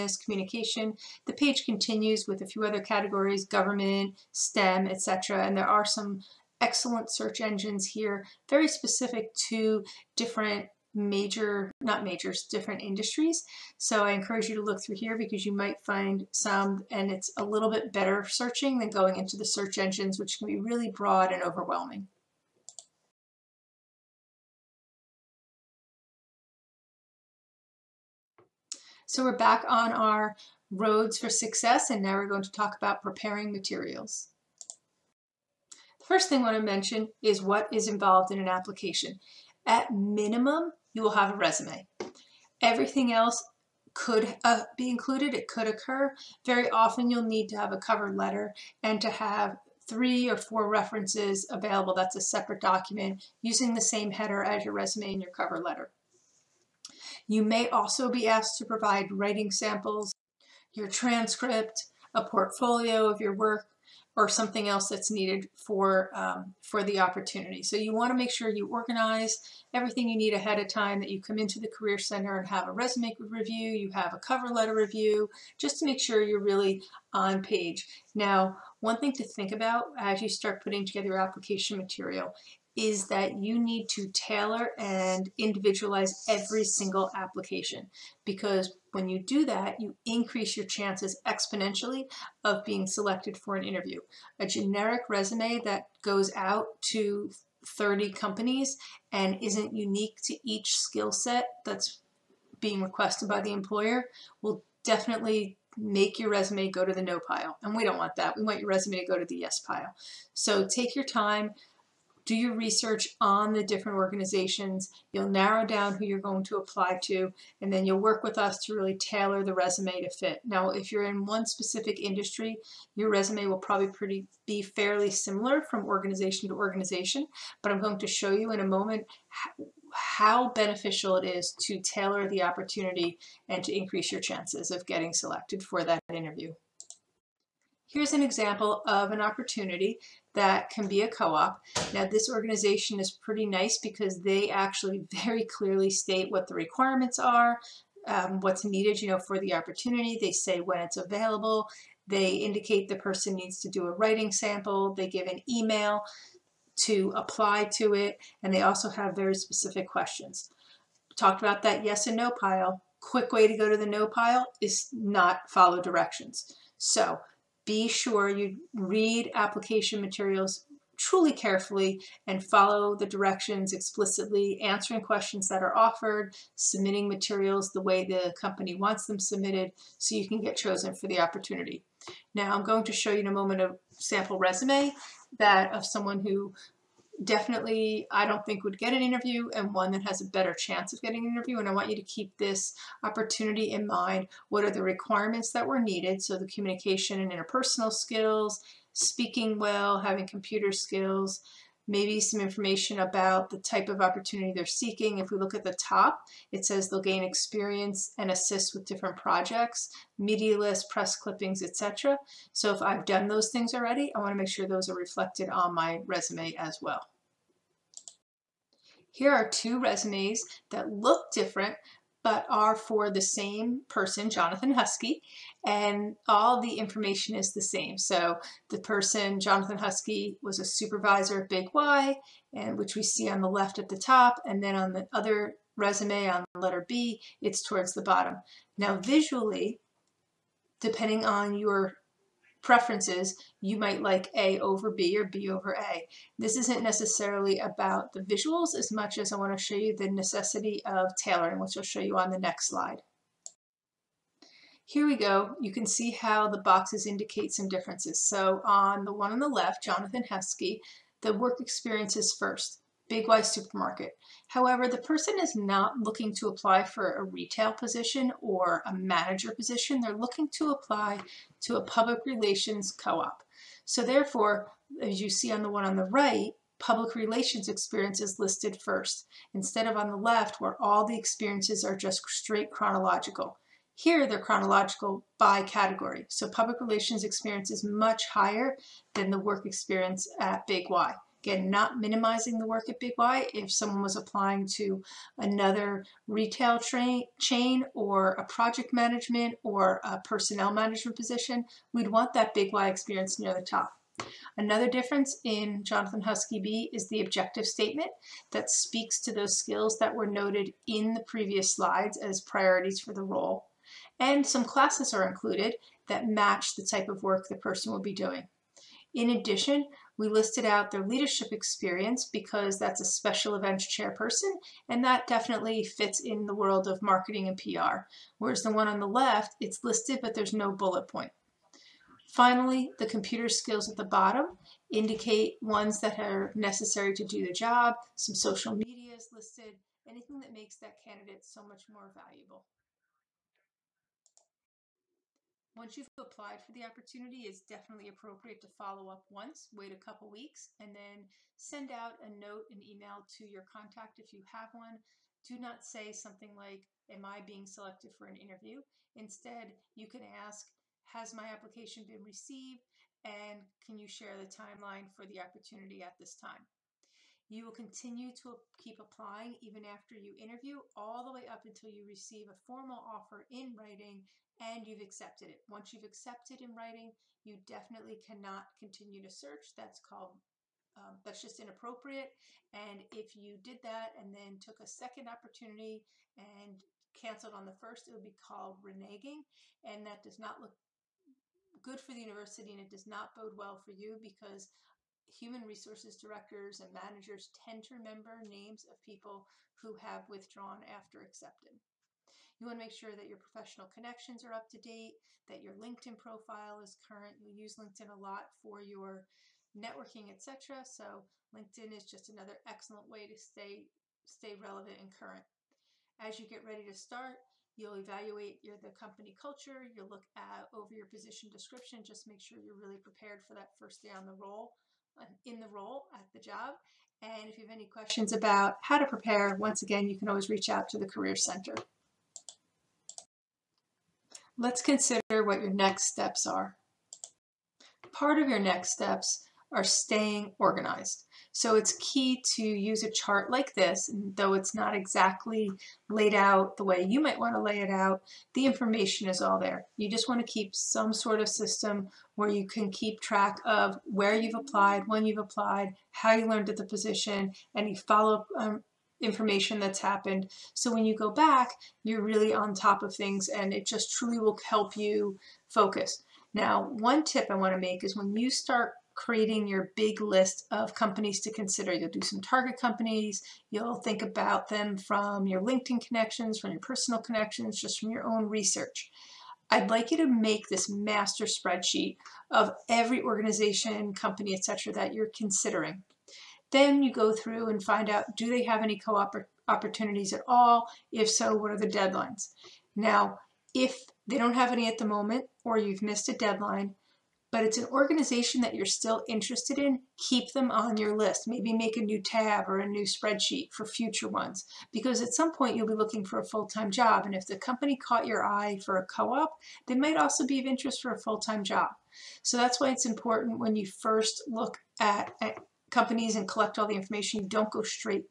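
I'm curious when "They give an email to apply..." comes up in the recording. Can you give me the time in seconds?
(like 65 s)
154 s.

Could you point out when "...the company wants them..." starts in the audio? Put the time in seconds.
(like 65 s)
178 s.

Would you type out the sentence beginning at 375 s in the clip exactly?
Once you've accepted in writing, you definitely cannot continue to search.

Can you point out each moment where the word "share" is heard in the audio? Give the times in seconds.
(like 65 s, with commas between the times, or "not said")
364 s.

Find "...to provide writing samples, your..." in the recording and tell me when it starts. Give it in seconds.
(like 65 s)
58 s.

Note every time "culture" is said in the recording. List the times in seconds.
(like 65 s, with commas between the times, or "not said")
419 s.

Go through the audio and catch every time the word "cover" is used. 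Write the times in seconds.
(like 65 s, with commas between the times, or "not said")
47 s, 55 s, 74 s.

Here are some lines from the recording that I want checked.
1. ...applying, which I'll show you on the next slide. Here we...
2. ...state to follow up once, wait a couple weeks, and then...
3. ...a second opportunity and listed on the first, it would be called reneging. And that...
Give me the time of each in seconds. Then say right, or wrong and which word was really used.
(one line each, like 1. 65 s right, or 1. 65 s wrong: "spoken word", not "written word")
1. 251 s wrong: "tailoring", not "applying"
2. 348 s wrong: "appropriate", not "state"
3. 384 s wrong: "canceled", not "listed".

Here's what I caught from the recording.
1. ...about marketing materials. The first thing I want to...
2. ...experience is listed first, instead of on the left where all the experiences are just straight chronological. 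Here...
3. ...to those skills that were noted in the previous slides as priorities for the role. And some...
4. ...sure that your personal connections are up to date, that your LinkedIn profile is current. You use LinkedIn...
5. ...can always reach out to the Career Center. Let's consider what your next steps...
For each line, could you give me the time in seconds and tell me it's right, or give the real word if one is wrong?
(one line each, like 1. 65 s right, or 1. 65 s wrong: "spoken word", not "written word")
1. 32 s wrong: "preparing", not "marketing"
2. 277 s right
3. 309 s right
4. 402 s wrong: "professional", not "personal"
5. 430 s right.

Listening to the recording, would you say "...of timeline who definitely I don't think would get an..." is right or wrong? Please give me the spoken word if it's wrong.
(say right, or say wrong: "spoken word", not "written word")
wrong: "someone", not "timeline".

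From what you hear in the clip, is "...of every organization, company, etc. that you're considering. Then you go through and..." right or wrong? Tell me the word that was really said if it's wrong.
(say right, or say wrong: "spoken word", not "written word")
right.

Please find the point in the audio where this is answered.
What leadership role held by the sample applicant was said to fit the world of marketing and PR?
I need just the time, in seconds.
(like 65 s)
323 s.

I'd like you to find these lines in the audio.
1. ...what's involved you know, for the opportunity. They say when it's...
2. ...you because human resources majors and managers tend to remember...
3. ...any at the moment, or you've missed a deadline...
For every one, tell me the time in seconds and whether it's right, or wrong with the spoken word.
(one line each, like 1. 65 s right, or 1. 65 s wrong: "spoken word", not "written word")
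1. 148 s wrong: "needed", not "involved"
2. 393 s wrong: "directors", not "majors"
3. 494 s right.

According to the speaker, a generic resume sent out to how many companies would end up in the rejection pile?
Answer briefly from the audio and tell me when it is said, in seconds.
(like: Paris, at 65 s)
30, at 97 s.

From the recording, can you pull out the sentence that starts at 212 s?
So if I've done those things already, I want to make sure those are reflected on my resume as well.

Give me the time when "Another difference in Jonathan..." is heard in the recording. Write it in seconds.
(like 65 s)
304 s.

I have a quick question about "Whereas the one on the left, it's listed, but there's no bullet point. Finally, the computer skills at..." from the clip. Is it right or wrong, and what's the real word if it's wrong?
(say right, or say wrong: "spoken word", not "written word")
right.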